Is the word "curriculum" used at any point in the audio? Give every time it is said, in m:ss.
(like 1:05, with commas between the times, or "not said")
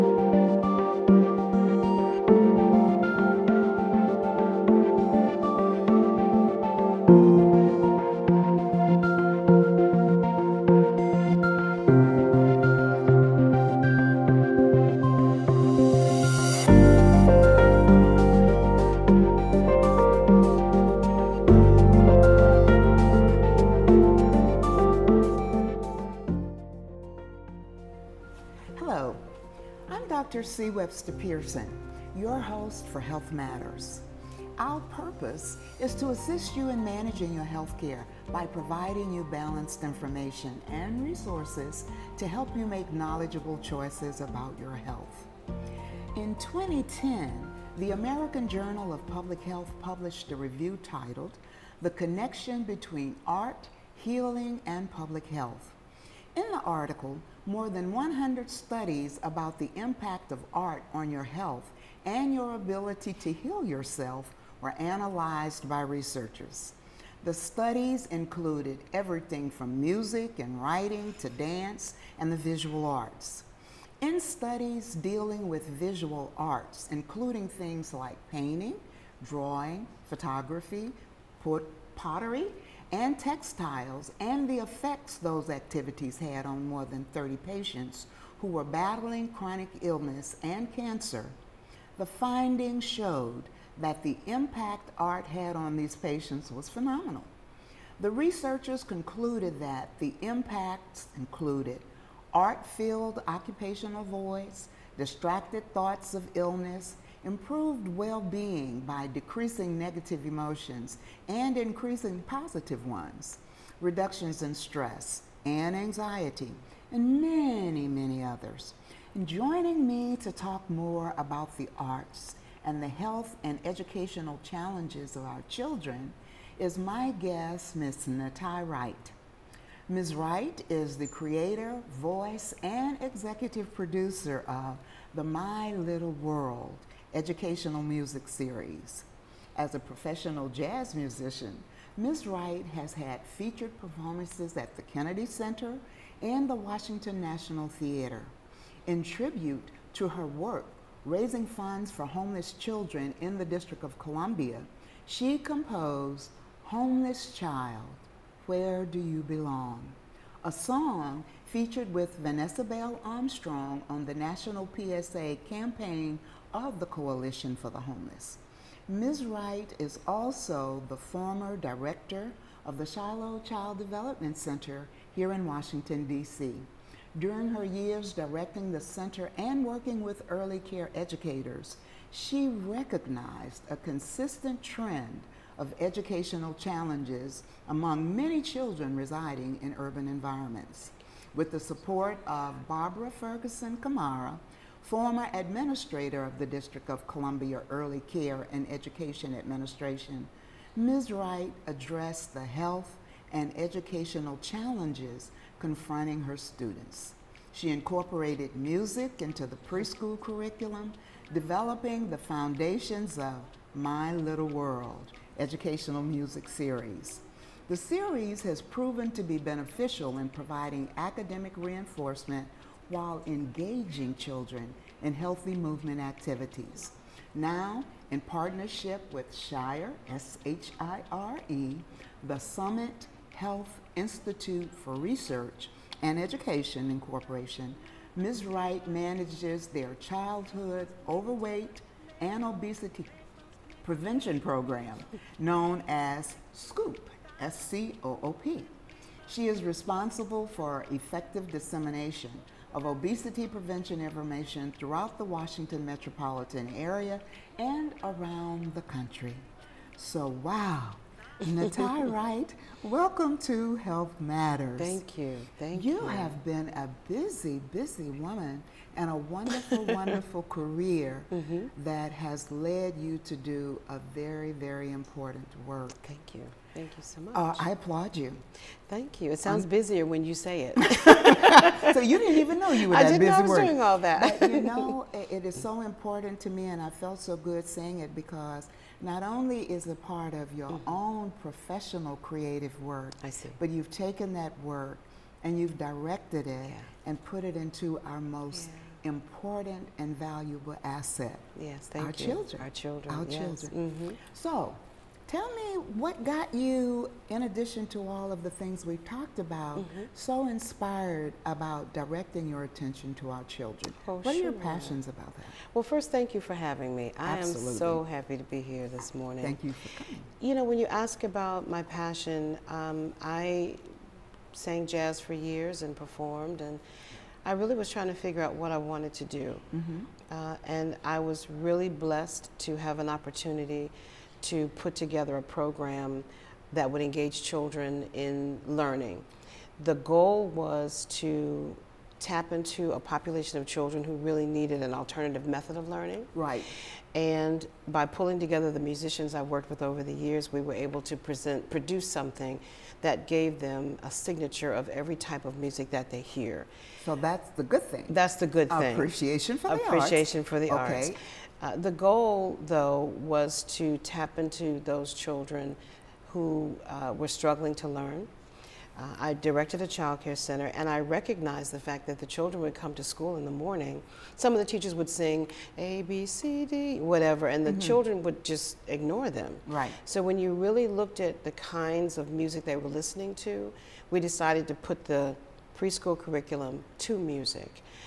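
3:30, 6:26.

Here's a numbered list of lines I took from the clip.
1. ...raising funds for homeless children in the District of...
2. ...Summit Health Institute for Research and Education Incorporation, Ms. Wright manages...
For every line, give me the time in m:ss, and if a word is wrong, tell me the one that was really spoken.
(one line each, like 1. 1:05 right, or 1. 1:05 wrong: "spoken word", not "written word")
1. 2:31 right
2. 3:52 right.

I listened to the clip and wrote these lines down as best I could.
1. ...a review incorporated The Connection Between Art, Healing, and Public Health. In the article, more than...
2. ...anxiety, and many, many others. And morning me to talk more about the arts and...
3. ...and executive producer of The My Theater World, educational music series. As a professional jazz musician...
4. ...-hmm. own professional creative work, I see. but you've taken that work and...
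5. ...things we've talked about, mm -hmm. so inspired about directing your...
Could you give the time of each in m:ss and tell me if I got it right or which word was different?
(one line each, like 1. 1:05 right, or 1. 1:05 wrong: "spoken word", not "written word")
1. 0:50 wrong: "titled", not "incorporated"
2. 1:55 wrong: "joining", not "morning"
3. 2:12 wrong: "Little", not "Theater"
4. 4:50 right
5. 5:08 right.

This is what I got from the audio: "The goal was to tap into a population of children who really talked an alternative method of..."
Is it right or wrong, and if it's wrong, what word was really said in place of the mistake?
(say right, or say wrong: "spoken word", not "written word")
wrong: "needed", not "talked".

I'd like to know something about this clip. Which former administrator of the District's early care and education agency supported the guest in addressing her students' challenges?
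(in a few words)
Barbara Ferguson Kamara.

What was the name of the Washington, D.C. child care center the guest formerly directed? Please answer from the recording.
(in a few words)
Shiloh Child Development Center.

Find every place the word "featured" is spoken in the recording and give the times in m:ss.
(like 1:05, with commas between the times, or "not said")
2:23, 2:41.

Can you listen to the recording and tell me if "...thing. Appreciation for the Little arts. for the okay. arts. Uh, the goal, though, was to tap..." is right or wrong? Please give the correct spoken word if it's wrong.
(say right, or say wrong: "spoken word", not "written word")
wrong: "Appreciation", not "Little".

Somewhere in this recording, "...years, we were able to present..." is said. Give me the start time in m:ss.
5:50.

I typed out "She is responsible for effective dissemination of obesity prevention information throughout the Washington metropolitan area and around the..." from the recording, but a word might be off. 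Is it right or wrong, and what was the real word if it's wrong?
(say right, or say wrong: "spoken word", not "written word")
right.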